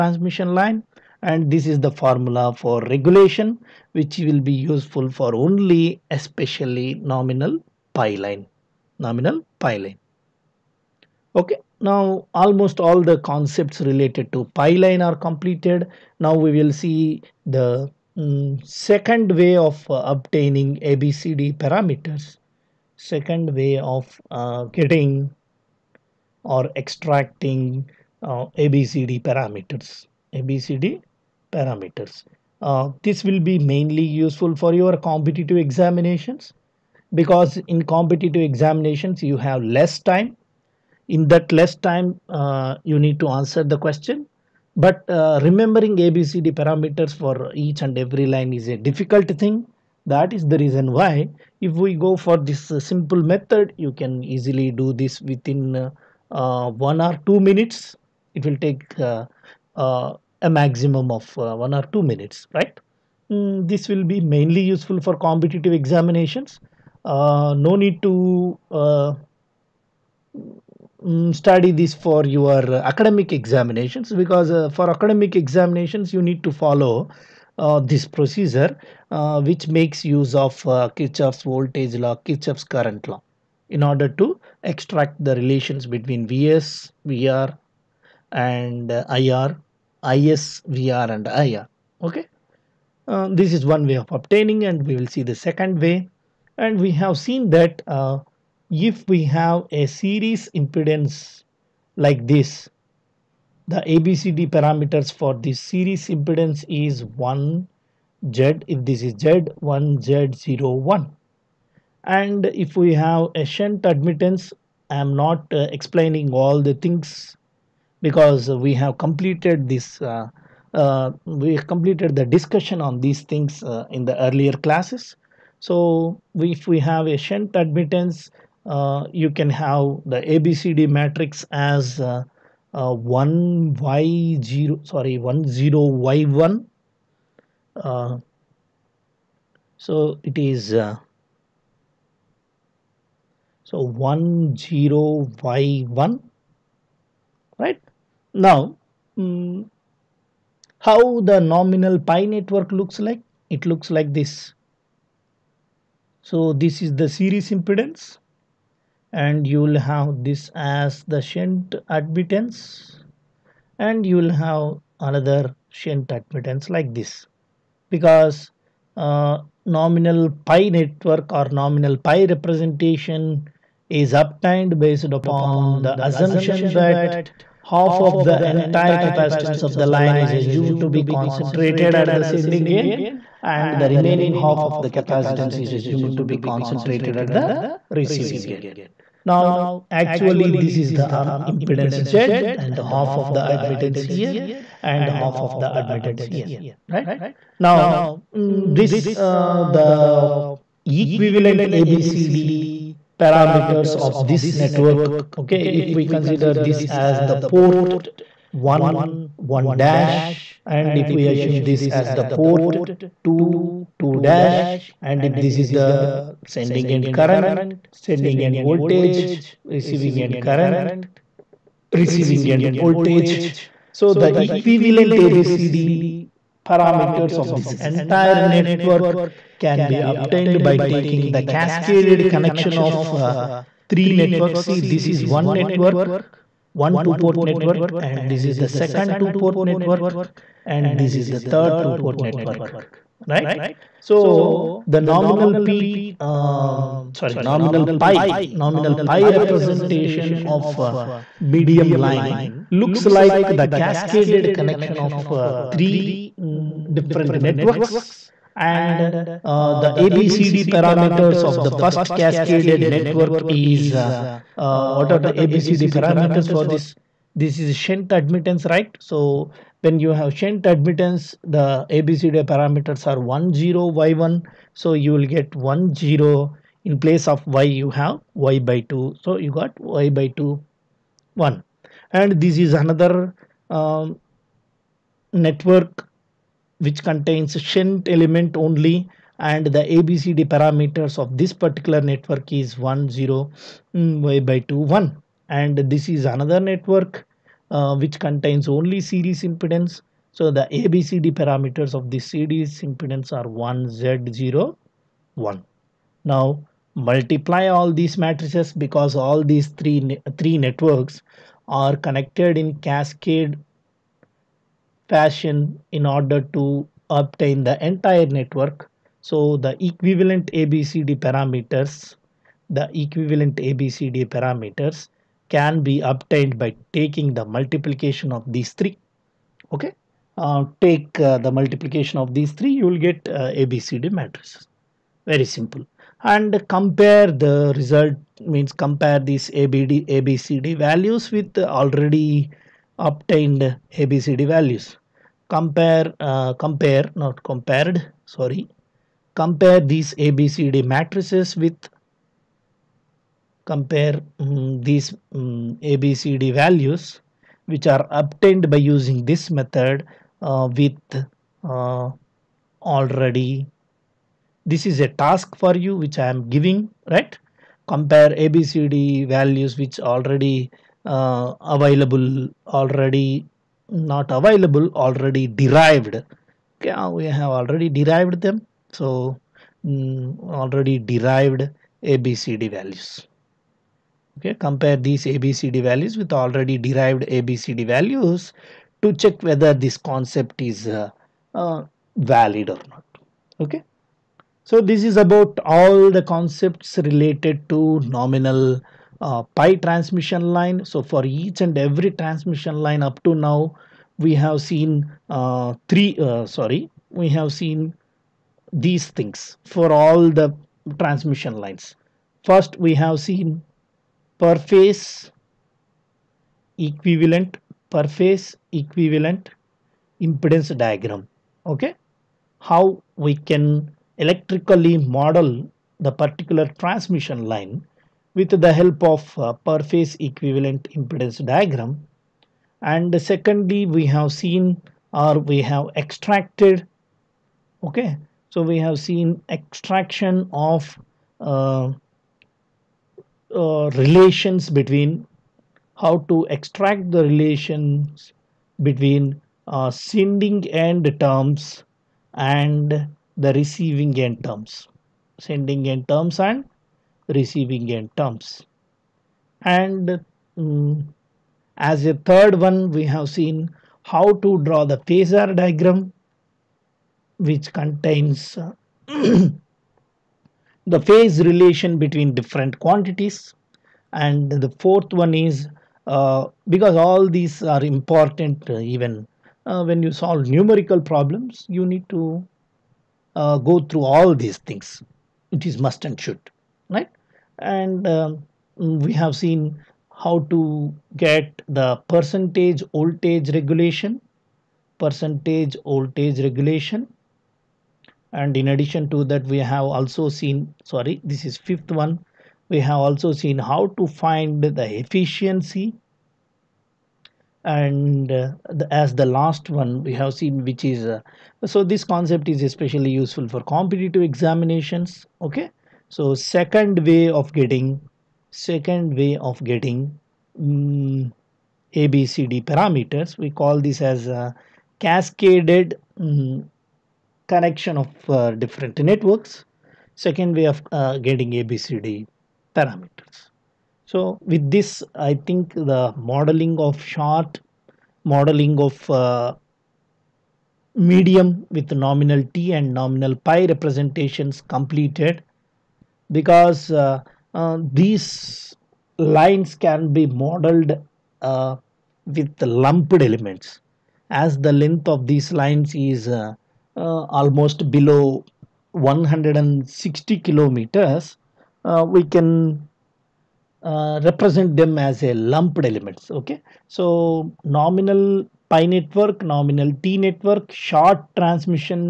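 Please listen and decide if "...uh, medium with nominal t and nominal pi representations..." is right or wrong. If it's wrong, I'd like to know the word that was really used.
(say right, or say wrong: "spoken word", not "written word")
right.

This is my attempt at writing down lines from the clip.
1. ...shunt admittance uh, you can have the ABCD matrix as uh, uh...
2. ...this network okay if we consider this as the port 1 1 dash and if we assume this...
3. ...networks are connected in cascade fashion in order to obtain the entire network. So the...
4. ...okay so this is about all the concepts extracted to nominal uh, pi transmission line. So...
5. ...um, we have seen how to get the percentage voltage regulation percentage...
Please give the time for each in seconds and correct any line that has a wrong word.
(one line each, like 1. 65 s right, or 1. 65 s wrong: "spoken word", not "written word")
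1. 127 s right
2. 204 s right
3. 310 s right
4. 393 s wrong: "related", not "extracted"
5. 488 s right.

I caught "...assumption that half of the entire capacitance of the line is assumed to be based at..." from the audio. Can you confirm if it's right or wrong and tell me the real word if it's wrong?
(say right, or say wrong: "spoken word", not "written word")
wrong: "concentrated", not "based".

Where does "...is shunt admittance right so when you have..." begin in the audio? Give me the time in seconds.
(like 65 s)
267 s.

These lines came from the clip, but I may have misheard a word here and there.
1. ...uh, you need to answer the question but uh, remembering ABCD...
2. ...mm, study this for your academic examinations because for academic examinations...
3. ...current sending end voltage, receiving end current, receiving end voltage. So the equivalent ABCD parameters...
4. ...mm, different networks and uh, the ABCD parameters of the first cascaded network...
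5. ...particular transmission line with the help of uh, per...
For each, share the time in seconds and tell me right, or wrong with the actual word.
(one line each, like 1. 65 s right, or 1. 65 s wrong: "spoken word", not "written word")
1. 42 s right
2. 68 s right
3. 217 s right
4. 256 s right
5. 426 s right.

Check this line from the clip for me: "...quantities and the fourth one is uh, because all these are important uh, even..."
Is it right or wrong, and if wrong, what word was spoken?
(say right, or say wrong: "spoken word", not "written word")
right.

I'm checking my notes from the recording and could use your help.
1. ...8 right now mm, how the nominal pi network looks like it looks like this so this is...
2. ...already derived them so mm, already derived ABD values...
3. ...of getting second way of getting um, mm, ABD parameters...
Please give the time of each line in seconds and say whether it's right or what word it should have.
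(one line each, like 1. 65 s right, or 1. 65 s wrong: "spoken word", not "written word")
1. 145 s wrong: "1", not "8"
2. 377 s wrong: "ABCD", not "ABD"
3. 517 s wrong: "ABCD", not "ABD".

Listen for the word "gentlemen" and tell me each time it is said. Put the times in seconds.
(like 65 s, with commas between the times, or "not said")
not said.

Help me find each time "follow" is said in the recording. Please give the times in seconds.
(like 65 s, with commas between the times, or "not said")
76 s.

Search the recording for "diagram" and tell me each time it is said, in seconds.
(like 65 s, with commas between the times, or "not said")
420 s, 431 s, 465 s.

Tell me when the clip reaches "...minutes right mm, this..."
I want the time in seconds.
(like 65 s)
62 s.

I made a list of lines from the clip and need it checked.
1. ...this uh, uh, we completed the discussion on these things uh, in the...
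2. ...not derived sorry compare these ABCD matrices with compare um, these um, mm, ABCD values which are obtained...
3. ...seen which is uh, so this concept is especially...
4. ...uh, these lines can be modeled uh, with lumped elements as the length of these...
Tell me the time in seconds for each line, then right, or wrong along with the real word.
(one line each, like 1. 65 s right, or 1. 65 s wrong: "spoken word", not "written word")
1. 119 s right
2. 347 s wrong: "compared", not "derived"
3. 510 s right
4. 547 s right.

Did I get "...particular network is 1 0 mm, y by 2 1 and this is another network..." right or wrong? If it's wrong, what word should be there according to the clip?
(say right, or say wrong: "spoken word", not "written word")
right.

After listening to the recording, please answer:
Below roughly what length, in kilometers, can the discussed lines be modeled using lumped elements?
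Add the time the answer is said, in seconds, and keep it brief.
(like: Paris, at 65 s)
160 kilometers, at 558 s.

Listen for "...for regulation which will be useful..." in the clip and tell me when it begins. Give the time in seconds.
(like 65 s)
2 s.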